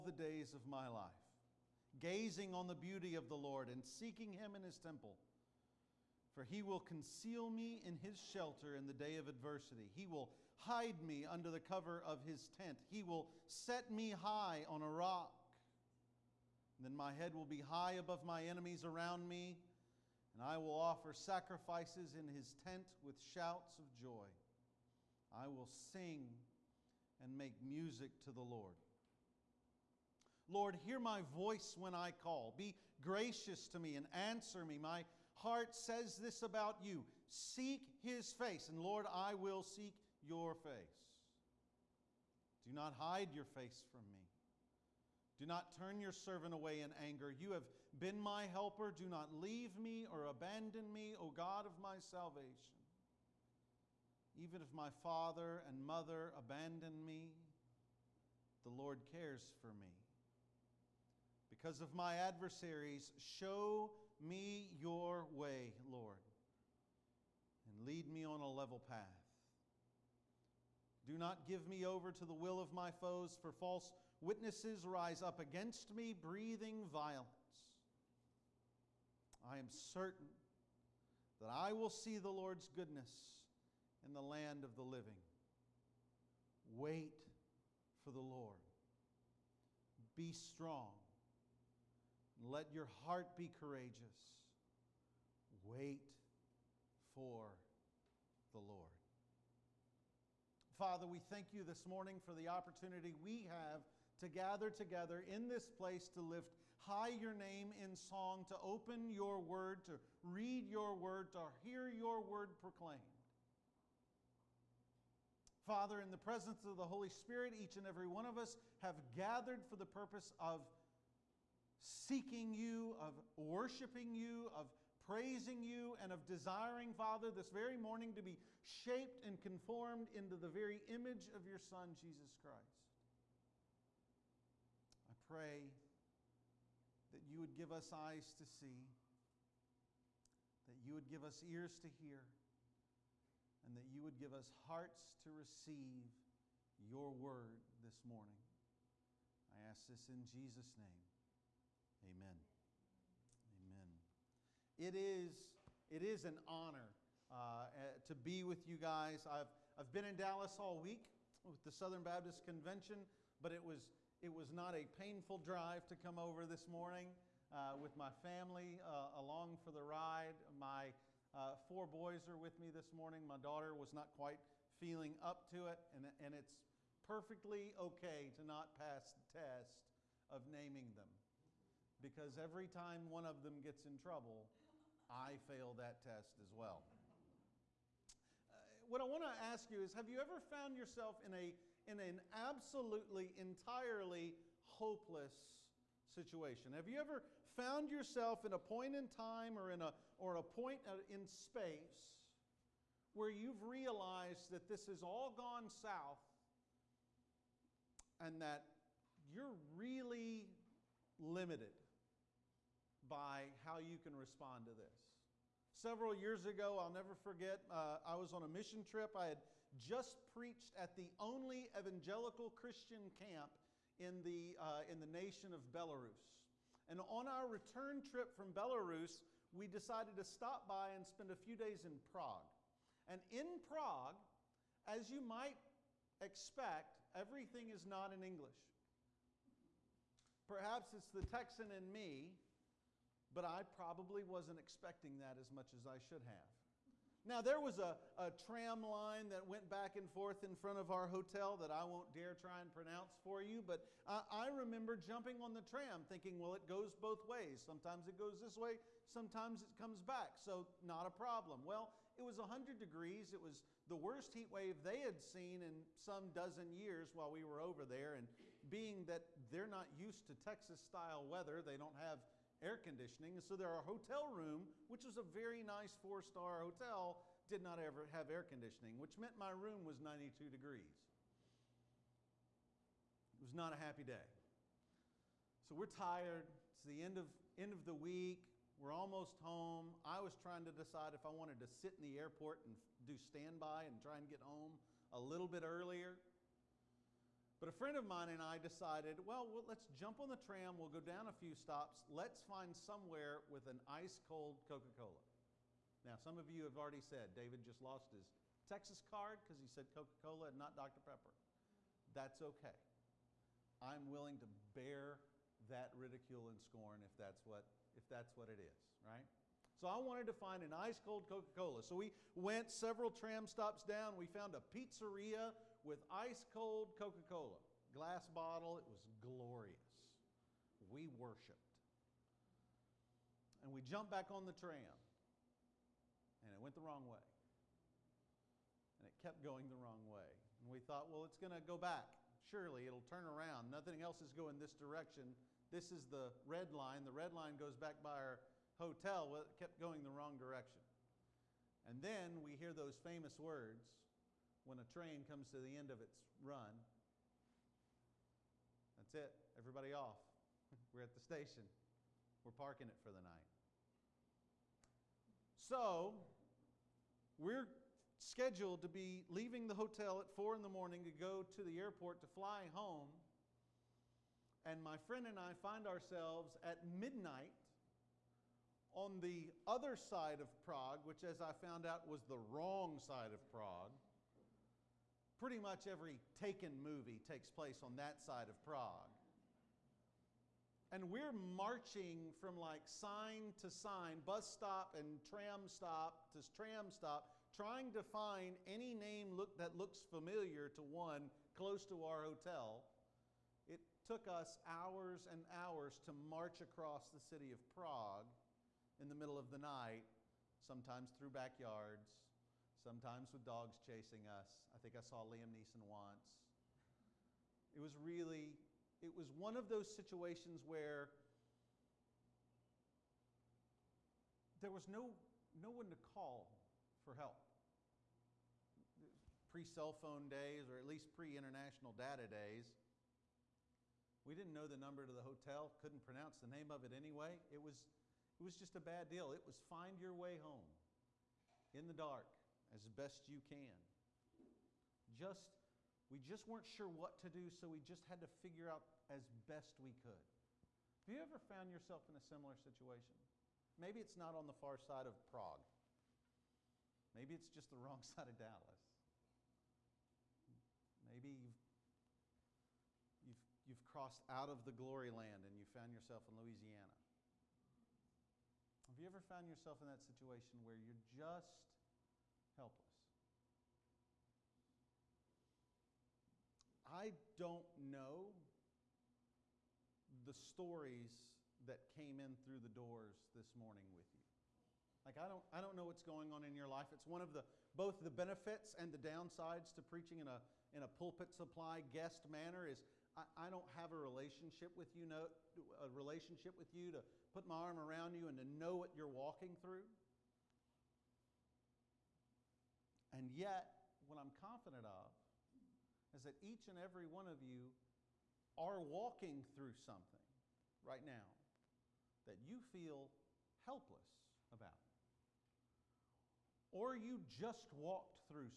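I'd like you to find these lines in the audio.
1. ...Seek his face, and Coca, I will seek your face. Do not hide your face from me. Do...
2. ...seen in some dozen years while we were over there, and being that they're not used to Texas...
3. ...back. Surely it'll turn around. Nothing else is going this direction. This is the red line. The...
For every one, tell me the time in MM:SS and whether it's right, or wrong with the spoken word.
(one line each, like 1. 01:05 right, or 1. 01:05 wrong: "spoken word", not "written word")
1. 00:37 wrong: "Lord", not "Coca"
2. 04:25 right
3. 05:41 right.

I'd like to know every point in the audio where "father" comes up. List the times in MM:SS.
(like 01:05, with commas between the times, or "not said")
00:54, 01:40, 01:55, 02:06.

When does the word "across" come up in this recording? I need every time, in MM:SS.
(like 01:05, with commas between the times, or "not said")
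06:46.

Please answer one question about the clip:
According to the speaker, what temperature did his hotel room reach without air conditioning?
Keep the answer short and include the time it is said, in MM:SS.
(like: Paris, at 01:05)
92 degrees, at 04:40.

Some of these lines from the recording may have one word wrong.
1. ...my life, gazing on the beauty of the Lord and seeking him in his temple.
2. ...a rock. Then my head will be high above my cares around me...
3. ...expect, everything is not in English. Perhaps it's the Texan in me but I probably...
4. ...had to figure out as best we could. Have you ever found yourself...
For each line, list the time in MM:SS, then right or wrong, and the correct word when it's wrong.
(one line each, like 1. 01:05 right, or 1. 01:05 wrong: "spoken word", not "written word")
1. 00:00 right
2. 00:14 wrong: "enemies", not "cares"
3. 03:56 right
4. 07:28 right.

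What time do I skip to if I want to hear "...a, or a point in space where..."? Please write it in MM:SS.
03:19.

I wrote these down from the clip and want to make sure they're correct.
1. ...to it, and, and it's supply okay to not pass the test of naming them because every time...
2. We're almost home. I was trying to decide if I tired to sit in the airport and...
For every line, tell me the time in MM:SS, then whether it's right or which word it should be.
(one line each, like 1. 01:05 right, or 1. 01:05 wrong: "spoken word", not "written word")
1. 02:55 wrong: "perfectly", not "supply"
2. 04:48 wrong: "wanted", not "tired".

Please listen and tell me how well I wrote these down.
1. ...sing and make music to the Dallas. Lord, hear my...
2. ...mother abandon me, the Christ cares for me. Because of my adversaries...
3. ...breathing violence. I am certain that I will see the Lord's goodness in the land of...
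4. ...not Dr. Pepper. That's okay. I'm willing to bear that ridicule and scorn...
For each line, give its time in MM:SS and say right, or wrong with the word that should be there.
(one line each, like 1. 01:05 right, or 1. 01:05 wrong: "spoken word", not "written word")
1. 00:25 wrong: "Lord", not "Dallas"
2. 00:55 wrong: "Lord", not "Christ"
3. 01:16 right
4. 05:10 right.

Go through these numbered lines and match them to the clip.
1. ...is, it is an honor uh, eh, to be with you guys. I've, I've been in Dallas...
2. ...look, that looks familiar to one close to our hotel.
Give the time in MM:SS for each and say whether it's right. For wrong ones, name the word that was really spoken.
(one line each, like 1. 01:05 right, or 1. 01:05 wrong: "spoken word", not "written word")
1. 02:34 right
2. 06:39 right.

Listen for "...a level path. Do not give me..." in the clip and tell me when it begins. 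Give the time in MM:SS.
01:08.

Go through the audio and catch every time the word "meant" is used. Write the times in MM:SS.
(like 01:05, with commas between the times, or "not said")
04:39.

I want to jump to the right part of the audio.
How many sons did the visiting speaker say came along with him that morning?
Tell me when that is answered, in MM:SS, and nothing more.
02:51.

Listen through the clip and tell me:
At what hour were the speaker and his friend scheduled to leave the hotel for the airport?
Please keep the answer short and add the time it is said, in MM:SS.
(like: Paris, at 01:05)
4 in the morning, at 06:10.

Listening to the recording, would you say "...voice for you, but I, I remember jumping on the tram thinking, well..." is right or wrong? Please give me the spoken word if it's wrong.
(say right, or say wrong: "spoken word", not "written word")
wrong: "pronounce", not "voice".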